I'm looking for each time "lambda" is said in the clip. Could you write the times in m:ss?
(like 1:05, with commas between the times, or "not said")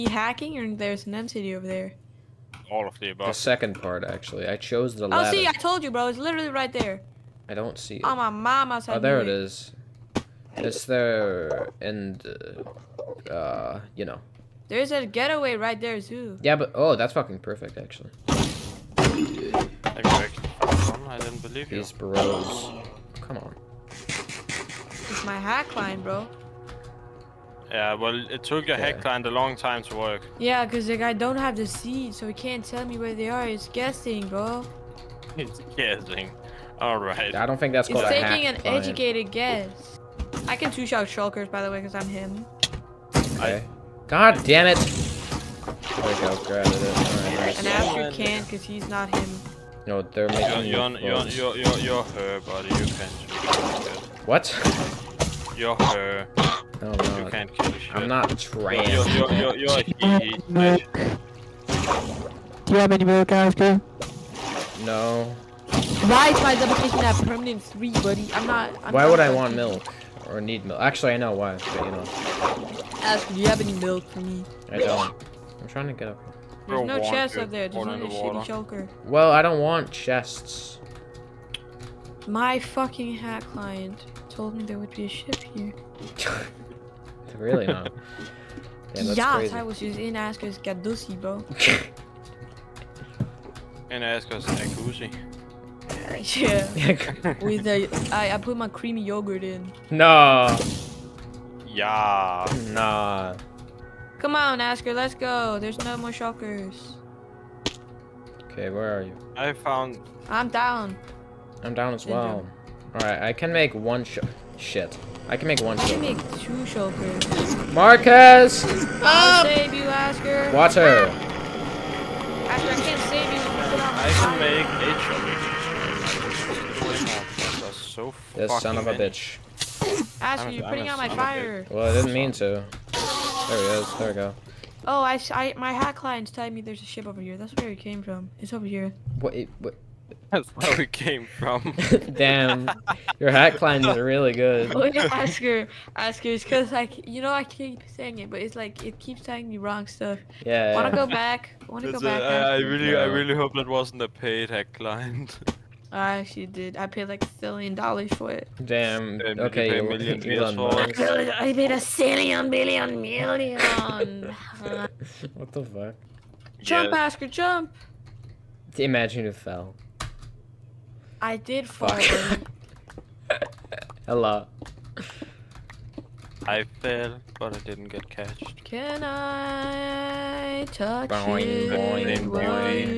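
not said.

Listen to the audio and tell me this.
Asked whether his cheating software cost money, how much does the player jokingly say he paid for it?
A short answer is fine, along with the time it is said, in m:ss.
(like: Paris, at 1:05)
a billion dollars, at 2:37.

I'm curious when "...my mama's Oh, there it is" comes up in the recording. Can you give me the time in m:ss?
0:08.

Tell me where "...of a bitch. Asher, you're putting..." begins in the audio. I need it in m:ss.
2:08.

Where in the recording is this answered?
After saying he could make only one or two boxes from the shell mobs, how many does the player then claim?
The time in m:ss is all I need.
2:04.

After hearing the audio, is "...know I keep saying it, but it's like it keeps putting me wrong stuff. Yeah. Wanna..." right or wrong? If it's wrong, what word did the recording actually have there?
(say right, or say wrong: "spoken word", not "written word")
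wrong: "telling", not "putting".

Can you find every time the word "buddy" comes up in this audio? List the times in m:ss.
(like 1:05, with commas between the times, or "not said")
0:52, 1:07.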